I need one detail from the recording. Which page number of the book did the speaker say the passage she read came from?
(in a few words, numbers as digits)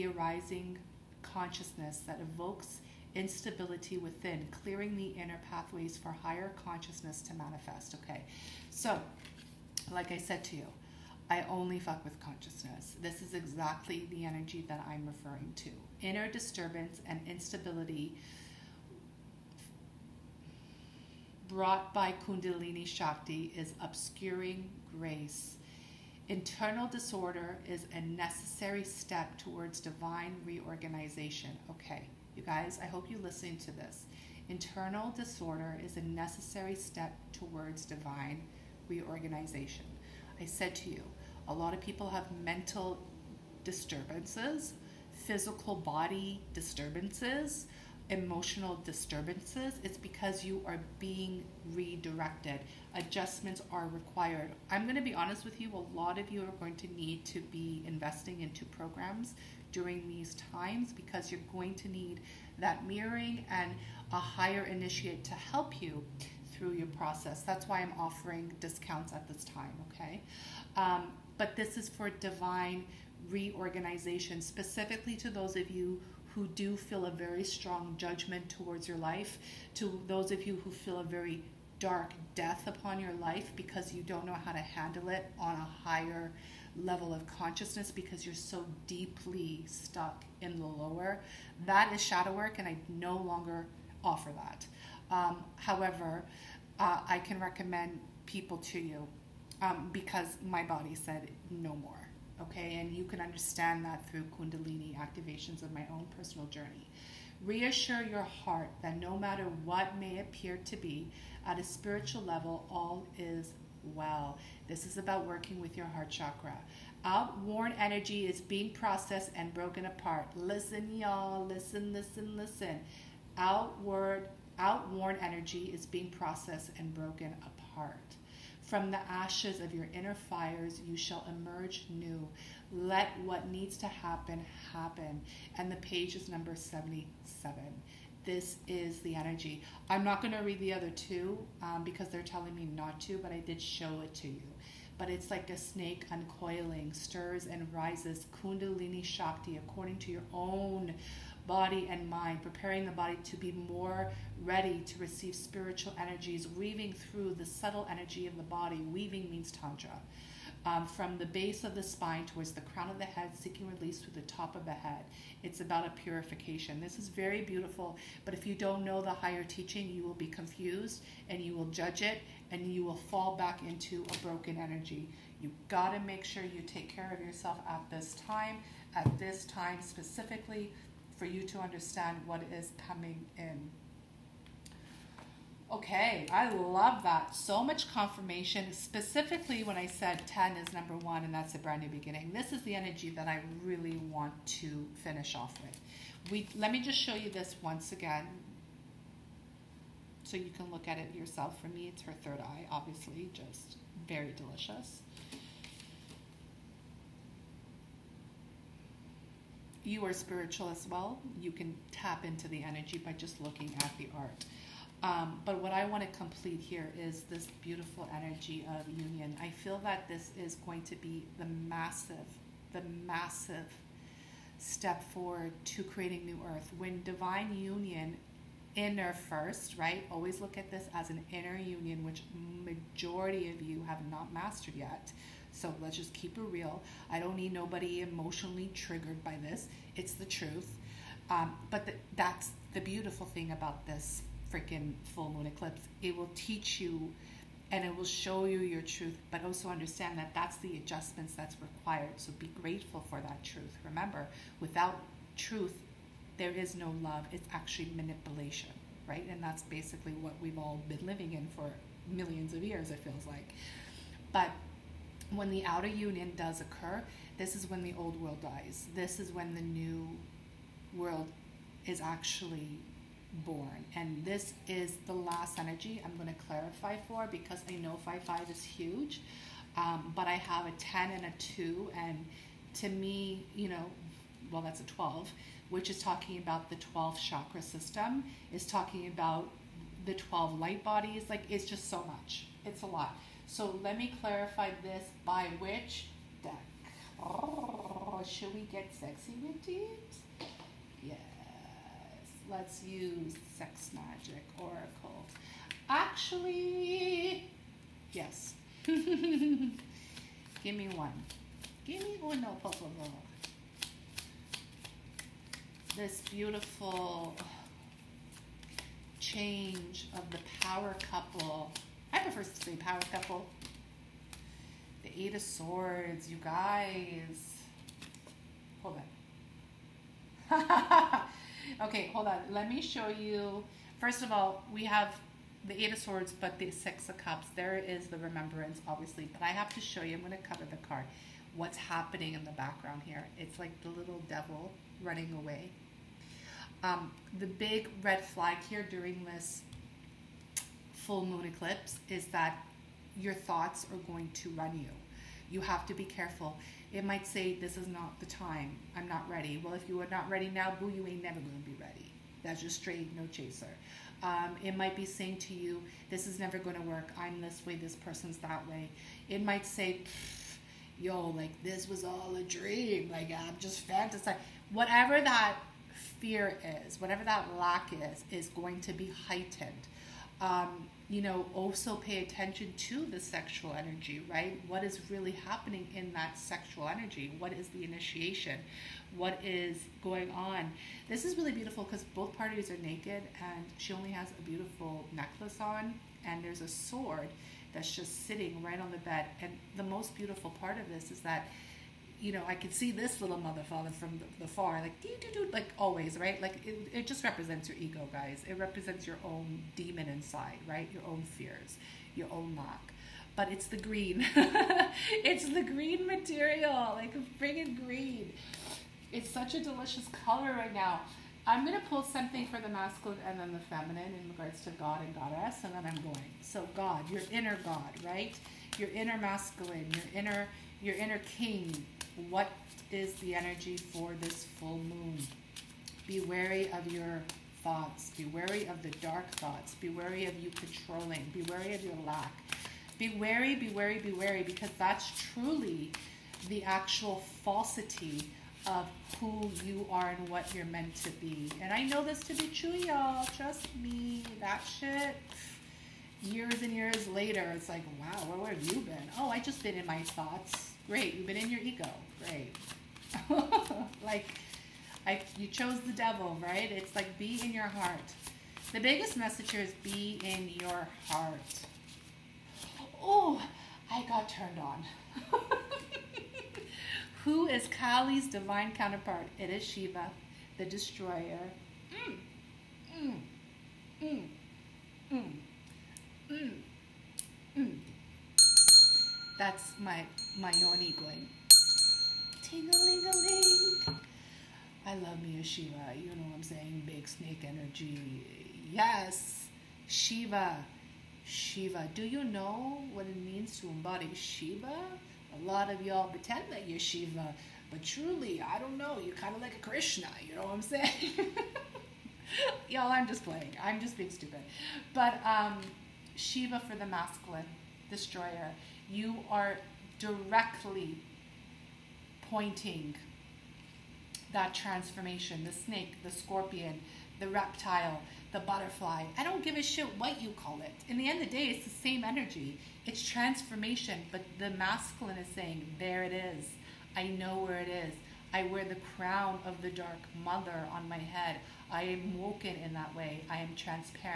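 77.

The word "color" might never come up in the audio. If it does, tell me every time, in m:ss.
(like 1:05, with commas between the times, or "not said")
7:00.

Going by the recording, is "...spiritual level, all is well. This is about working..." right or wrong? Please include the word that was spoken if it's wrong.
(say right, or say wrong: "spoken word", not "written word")
right.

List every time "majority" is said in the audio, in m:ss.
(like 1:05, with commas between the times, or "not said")
3:52.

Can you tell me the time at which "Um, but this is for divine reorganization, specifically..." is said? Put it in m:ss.
1:10.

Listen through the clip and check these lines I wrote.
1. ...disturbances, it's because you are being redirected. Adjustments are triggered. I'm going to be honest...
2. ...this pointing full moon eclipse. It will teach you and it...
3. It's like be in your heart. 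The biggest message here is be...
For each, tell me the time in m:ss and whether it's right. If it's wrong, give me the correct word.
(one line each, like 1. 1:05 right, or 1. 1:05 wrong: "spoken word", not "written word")
1. 0:48 wrong: "required", not "triggered"
2. 4:03 wrong: "freaking", not "pointing"
3. 7:46 right.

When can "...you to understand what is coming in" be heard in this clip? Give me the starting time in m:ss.
3:01.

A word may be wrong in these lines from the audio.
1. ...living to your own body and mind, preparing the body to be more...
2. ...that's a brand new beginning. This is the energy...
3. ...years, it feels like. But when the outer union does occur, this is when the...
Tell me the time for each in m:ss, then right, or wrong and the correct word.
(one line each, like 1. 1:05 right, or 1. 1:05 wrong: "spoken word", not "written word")
1. 2:29 wrong: "according", not "living"
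2. 3:11 right
3. 4:22 right.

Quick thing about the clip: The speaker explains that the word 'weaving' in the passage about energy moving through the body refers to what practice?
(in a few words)
Tantra.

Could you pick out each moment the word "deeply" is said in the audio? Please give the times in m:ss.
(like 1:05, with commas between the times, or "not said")
1:28.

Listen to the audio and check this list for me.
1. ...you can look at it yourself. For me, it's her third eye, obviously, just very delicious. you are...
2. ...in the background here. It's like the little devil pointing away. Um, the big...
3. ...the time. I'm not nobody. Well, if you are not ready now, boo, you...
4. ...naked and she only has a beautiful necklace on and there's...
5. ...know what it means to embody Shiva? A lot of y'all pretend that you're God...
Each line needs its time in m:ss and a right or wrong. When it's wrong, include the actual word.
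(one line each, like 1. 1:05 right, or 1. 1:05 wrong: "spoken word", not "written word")
1. 3:20 right
2. 5:42 wrong: "running", not "pointing"
3. 5:58 wrong: "ready", not "nobody"
4. 6:32 right
5. 8:22 wrong: "Shiva", not "God".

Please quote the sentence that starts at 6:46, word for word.
Like it, it just represents your ego, guys.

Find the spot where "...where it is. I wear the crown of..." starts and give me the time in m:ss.
8:57.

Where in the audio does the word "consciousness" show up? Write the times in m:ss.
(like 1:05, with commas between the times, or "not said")
0:01, 0:06, 0:12, 1:27.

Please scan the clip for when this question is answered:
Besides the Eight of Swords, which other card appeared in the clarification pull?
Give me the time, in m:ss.
5:36.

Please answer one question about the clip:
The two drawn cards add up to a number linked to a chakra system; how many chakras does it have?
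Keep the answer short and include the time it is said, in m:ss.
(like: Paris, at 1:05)
12, at 4:46.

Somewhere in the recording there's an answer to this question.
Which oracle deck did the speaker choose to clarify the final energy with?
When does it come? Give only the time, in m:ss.
5:03.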